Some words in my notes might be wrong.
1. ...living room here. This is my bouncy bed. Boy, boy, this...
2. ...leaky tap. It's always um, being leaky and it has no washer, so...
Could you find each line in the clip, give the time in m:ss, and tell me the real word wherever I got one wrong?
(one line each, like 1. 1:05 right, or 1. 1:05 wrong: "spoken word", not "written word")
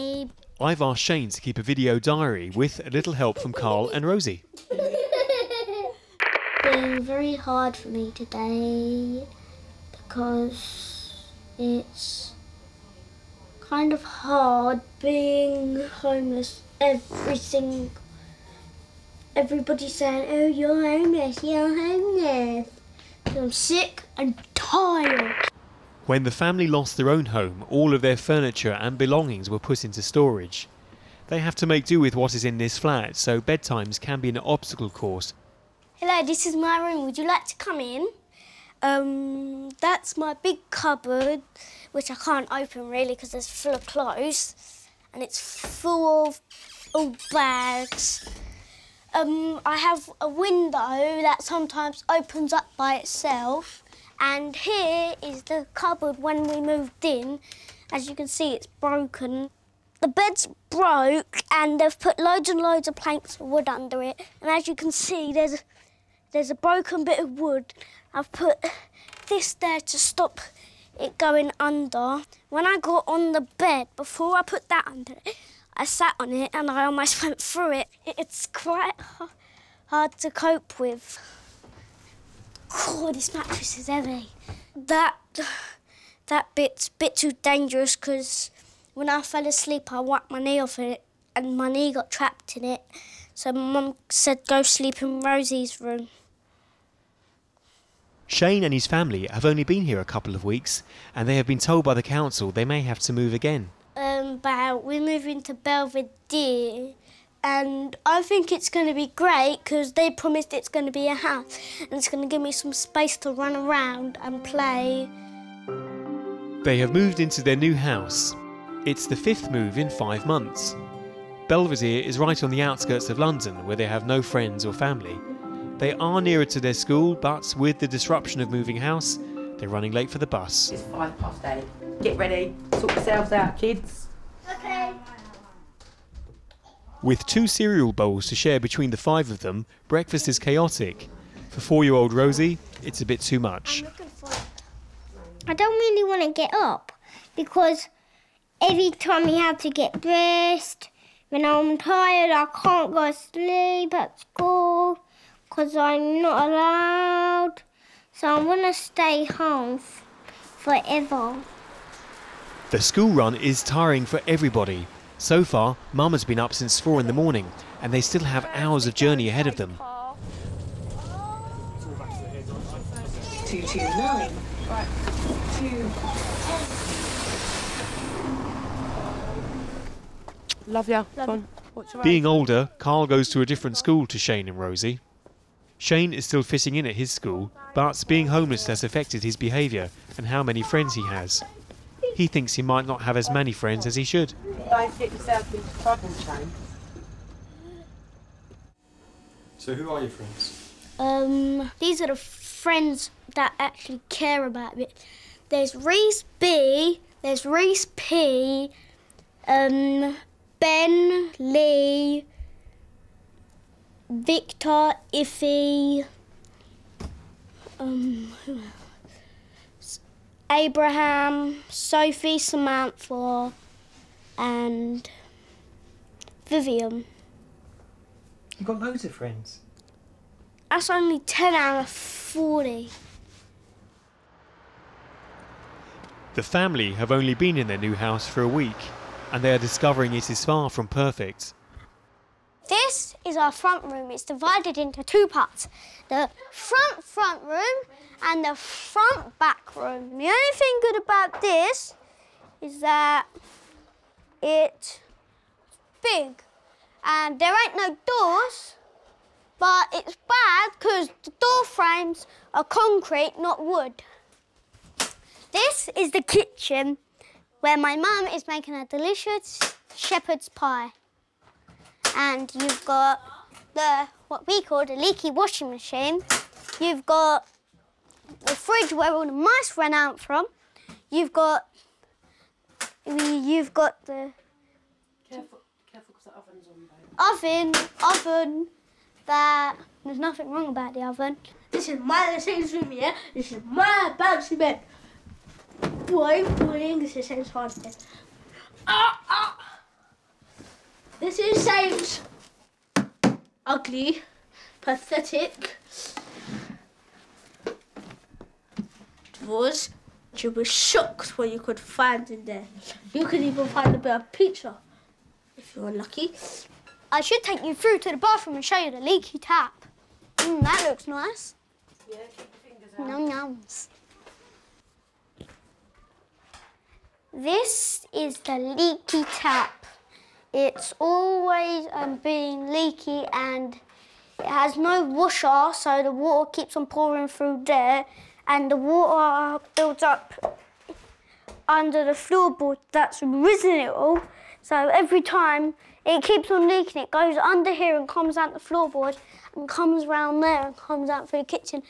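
1. 4:52 right
2. 5:28 right.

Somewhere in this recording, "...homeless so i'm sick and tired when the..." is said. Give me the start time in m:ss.
0:21.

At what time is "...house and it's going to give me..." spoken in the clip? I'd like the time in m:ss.
1:51.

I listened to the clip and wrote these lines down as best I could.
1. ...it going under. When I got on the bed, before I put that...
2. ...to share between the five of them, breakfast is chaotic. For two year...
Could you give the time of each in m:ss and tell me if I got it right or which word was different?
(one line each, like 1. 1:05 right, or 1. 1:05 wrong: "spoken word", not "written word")
1. 1:10 right
2. 2:18 wrong: "four", not "two".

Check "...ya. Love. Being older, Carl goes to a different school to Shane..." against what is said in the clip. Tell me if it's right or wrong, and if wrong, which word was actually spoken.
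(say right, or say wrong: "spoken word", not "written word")
right.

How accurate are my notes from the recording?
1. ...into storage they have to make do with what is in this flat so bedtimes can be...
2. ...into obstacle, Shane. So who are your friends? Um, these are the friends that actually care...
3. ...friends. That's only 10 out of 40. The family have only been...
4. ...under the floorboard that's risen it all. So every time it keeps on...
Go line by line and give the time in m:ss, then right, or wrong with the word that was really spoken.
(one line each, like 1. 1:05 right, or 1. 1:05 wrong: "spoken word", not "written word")
1. 0:29 right
2. 3:15 wrong: "trouble", not "obstacle"
3. 3:49 right
4. 5:41 right.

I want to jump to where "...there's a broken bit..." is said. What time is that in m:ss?
1:06.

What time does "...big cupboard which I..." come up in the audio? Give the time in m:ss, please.
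0:40.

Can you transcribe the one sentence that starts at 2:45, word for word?
So far, Mum has been up since four in the morning and they still have hours of journey ahead of them.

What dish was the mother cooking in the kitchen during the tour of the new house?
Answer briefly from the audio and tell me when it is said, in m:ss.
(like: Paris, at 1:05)
shepherd's pie, at 4:29.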